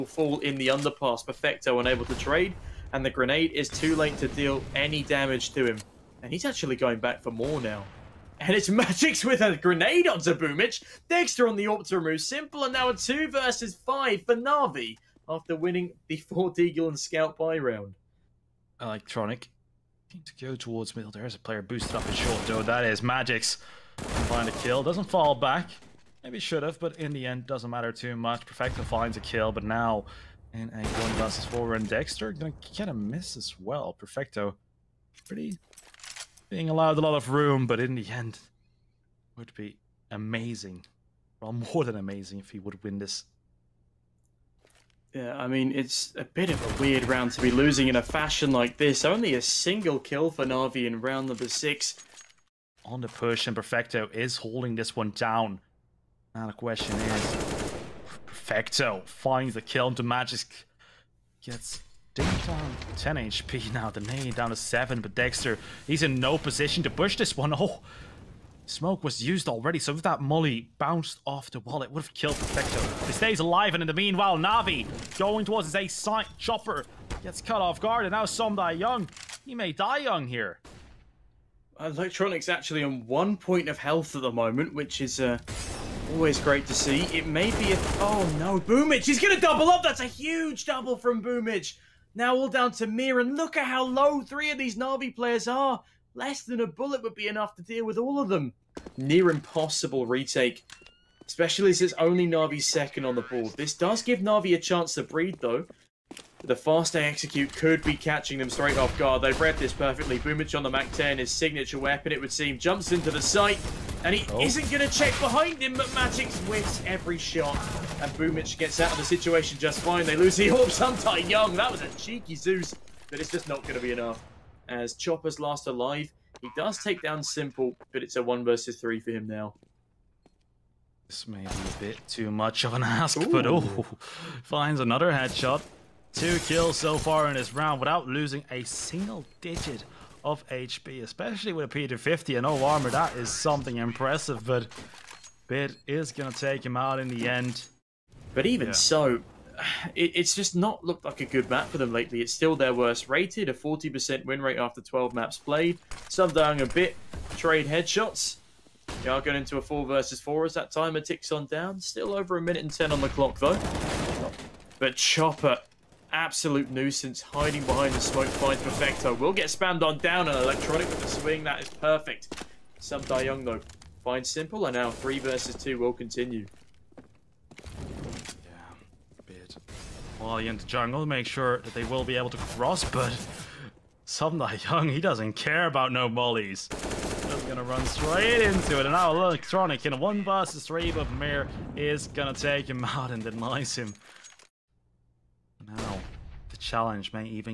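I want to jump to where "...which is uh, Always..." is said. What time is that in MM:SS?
01:24.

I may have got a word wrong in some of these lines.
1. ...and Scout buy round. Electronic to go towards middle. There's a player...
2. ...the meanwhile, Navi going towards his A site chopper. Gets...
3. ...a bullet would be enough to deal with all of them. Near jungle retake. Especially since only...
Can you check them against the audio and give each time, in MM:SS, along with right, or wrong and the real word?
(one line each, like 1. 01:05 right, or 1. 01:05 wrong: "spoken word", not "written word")
1. 00:16 right
2. 01:13 right
3. 01:36 wrong: "impossible", not "jungle".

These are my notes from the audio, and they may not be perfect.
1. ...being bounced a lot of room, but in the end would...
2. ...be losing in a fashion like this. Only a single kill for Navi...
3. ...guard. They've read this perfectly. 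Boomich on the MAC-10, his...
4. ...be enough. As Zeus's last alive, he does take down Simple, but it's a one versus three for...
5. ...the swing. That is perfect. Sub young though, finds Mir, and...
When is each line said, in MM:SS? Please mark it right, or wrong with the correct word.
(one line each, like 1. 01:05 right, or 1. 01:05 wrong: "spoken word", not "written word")
1. 00:36 wrong: "allowed", not "bounced"
2. 00:47 right
3. 01:48 right
4. 02:03 wrong: "Chopper", not "Zeus"
5. 02:51 wrong: "Simple", not "Mir".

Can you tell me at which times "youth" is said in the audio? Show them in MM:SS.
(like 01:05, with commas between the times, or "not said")
not said.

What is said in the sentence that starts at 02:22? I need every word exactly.
That is something impressive, but Bit is going to take him out in the end.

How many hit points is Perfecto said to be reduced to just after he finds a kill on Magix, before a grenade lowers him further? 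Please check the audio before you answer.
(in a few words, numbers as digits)
10.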